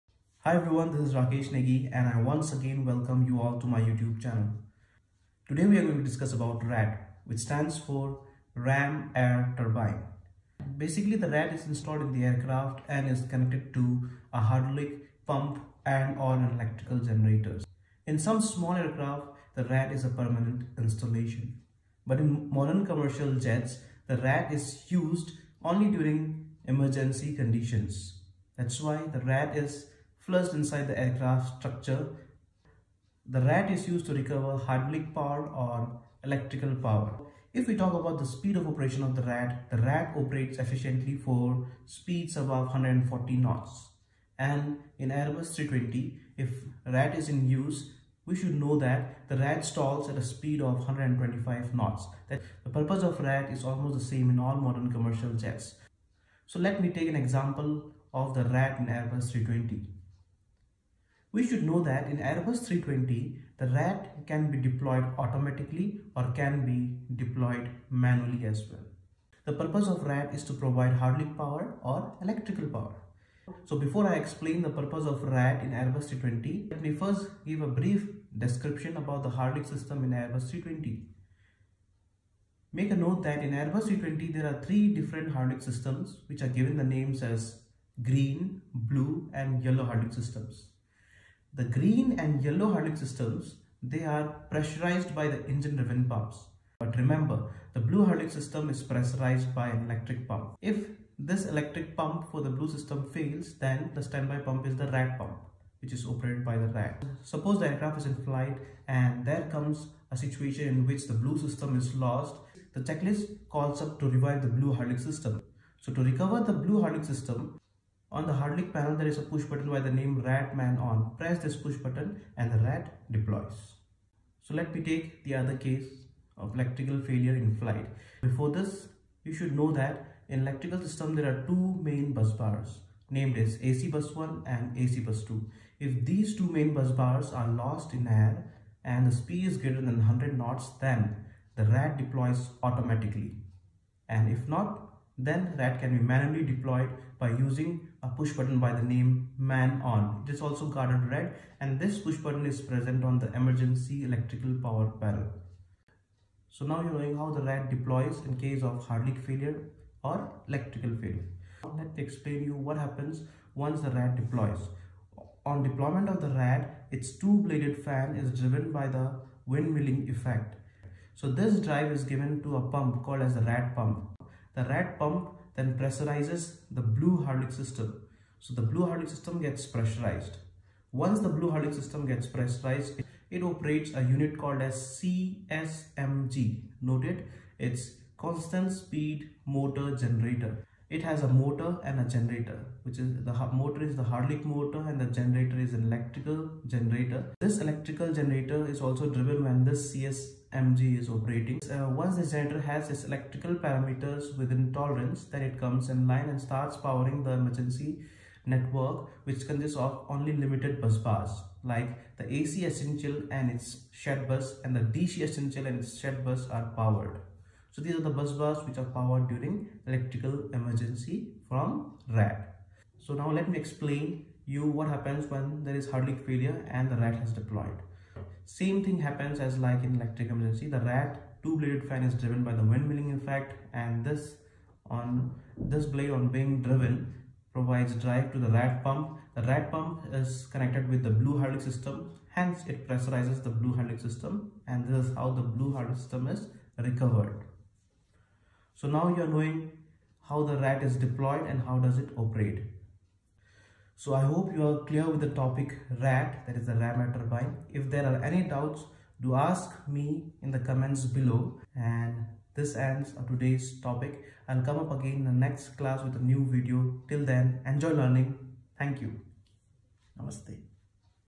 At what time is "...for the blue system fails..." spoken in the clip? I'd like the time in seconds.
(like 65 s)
102 s.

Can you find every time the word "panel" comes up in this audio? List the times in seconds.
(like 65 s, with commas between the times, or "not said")
118 s, 154 s.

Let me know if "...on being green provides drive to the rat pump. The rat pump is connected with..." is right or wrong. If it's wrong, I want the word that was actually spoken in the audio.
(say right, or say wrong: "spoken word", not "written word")
wrong: "driven", not "green".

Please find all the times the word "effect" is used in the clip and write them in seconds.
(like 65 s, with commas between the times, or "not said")
170 s, 233 s.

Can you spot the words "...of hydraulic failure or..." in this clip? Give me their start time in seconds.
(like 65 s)
158 s.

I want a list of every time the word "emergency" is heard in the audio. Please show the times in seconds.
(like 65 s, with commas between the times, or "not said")
26 s, 153 s, 207 s, 220 s, 230 s.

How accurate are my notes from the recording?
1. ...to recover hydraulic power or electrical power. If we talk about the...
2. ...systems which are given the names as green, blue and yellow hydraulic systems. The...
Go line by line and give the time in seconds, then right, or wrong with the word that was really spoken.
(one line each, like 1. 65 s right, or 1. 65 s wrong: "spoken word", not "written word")
1. 34 s right
2. 85 s right.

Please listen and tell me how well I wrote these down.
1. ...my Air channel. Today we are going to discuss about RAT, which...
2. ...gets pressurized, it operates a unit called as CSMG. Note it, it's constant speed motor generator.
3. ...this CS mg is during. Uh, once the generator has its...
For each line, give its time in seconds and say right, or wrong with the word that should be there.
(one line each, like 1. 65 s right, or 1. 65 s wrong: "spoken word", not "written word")
1. 3 s wrong: "YouTube", not "Air"
2. 182 s right
3. 199 s wrong: "operating", not "during".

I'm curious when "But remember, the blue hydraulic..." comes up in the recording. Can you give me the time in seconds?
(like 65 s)
96 s.